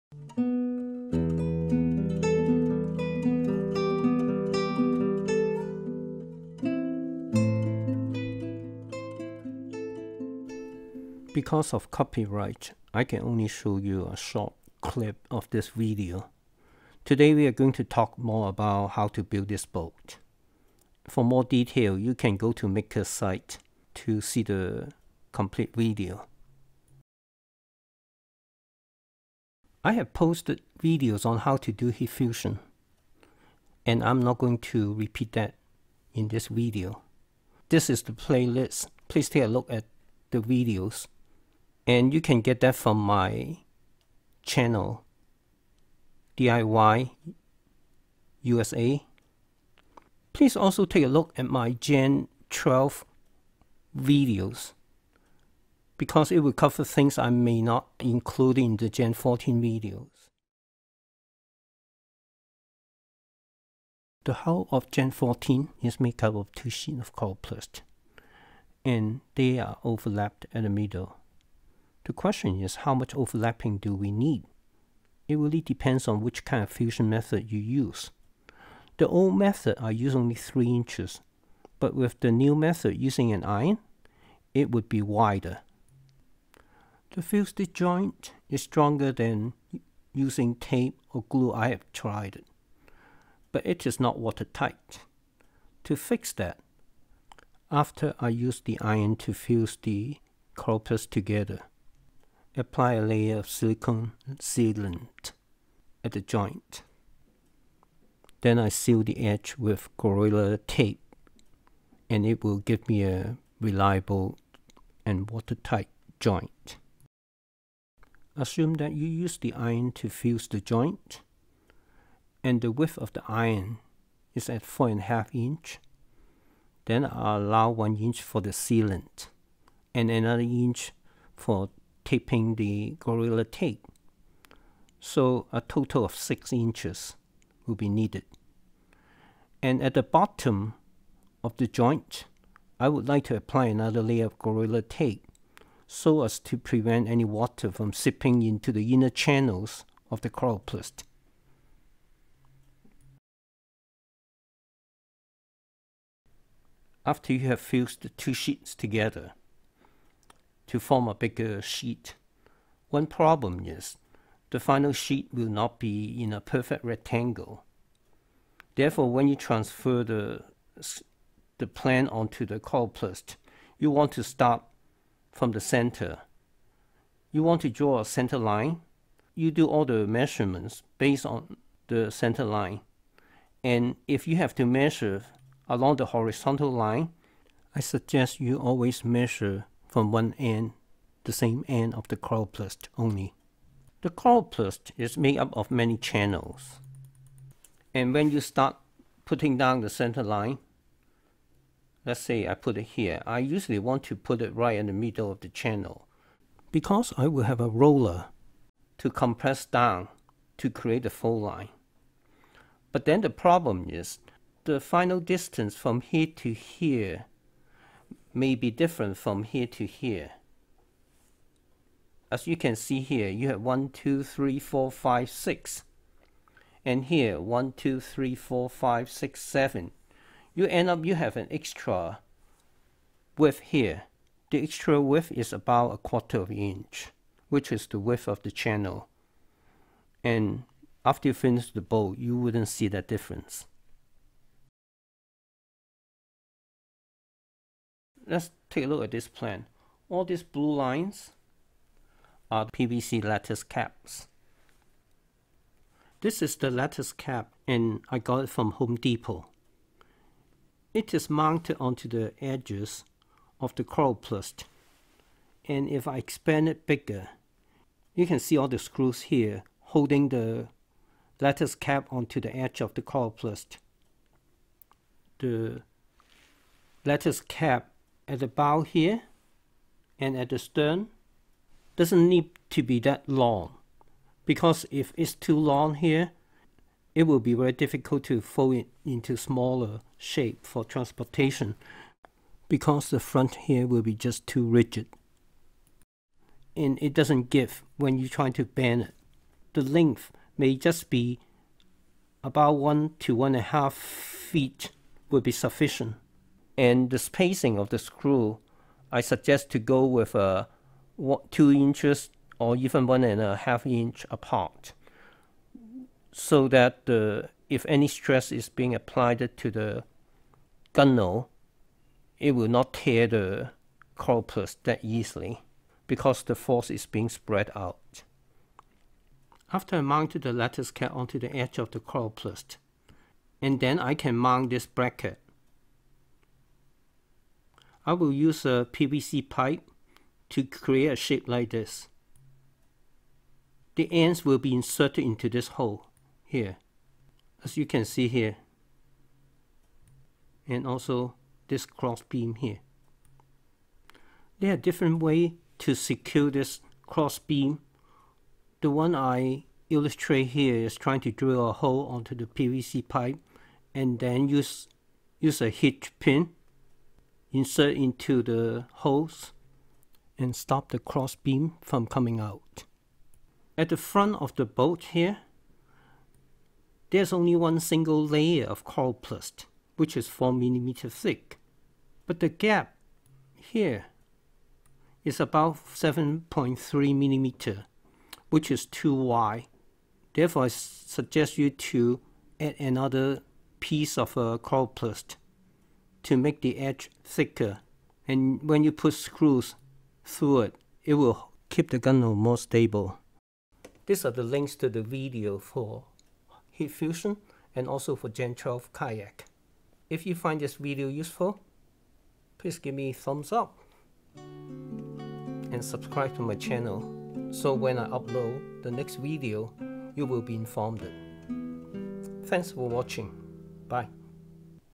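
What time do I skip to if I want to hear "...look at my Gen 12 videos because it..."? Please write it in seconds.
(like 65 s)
51 s.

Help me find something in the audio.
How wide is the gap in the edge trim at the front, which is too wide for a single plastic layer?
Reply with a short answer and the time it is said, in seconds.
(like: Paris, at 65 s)
7.3 millimeters, at 385 s.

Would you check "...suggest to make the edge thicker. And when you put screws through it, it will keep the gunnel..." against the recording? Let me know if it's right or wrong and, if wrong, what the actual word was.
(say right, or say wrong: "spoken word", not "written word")
wrong: "coroplast", not "suggest".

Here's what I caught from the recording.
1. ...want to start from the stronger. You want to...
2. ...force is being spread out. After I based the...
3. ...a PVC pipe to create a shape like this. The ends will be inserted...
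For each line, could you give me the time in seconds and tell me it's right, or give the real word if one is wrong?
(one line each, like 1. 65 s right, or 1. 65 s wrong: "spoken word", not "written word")
1. 173 s wrong: "center", not "stronger"
2. 326 s wrong: "mounted", not "based"
3. 338 s right.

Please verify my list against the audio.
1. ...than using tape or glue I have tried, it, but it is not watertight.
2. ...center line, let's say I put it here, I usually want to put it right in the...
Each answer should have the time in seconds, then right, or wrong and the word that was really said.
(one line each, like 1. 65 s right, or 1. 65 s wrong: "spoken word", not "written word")
1. 89 s right
2. 199 s right.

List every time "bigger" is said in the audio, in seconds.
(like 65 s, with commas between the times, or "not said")
161 s, 266 s.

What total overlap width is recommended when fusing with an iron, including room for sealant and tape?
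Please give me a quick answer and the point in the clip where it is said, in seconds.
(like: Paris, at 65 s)
6 inches, at 136 s.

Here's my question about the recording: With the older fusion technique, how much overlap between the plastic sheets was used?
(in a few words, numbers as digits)
3 inches.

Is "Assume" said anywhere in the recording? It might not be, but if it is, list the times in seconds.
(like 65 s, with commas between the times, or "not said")
118 s.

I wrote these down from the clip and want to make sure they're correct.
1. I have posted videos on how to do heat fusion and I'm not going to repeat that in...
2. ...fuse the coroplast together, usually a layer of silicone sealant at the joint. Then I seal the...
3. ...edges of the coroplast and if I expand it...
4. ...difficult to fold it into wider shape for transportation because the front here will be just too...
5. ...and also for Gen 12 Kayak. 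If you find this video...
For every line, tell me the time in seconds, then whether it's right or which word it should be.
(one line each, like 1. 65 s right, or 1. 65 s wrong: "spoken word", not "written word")
1. 29 s right
2. 99 s wrong: "apply", not "usually"
3. 262 s right
4. 287 s wrong: "smaller", not "wider"
5. 407 s right.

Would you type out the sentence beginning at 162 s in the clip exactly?
One problem is the final sheet will not be in a perfect rectangle.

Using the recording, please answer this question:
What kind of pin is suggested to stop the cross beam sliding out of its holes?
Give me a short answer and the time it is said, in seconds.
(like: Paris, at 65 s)
hitch pin, at 365 s.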